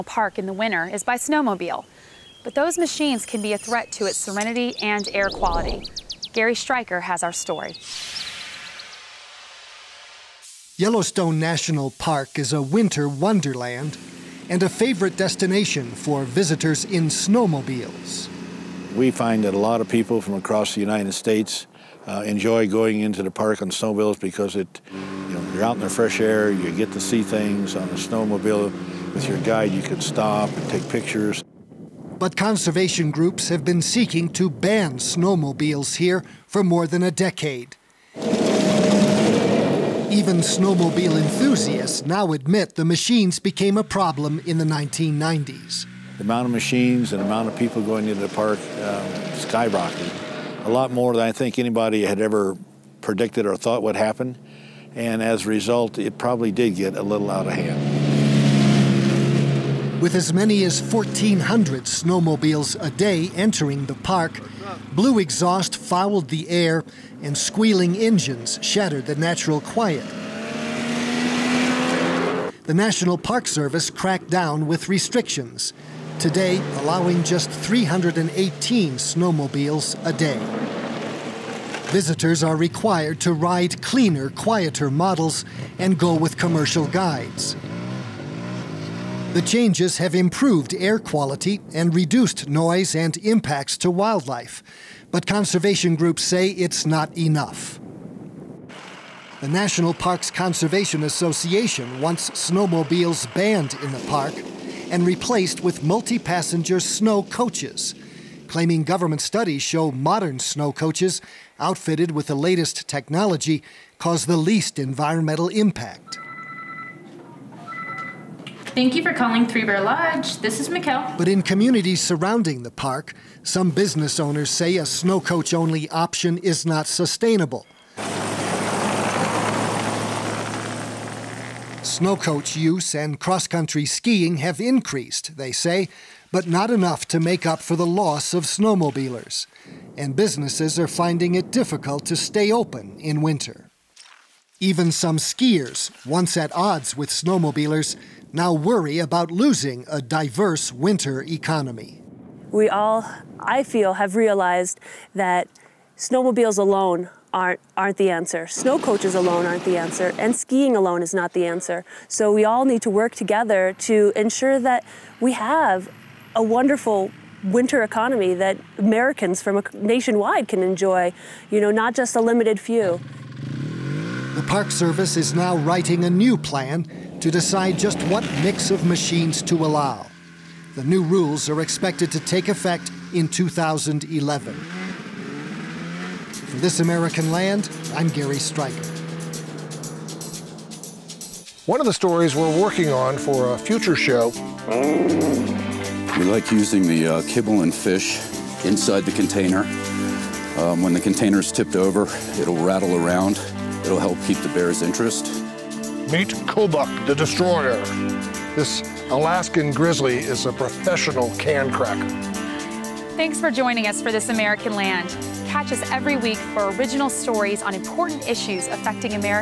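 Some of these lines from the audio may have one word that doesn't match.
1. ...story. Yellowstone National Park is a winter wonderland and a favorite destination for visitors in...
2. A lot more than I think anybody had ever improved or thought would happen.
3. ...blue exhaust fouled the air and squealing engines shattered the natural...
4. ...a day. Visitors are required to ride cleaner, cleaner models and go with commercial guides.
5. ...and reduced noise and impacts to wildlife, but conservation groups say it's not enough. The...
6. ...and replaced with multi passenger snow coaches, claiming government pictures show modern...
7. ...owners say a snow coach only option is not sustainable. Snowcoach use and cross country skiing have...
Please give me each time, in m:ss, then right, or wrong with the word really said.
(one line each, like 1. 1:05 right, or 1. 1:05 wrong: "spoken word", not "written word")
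1. 0:07 right
2. 0:50 wrong: "predicted", not "improved"
3. 1:04 right
4. 1:20 wrong: "quieter", not "cleaner"
5. 1:31 right
6. 1:44 wrong: "studies", not "pictures"
7. 2:04 right.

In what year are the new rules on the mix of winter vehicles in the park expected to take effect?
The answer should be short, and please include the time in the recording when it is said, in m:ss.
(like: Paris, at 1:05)
2011, at 3:03.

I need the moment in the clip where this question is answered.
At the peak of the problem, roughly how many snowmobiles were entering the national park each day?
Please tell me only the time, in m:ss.
1:00.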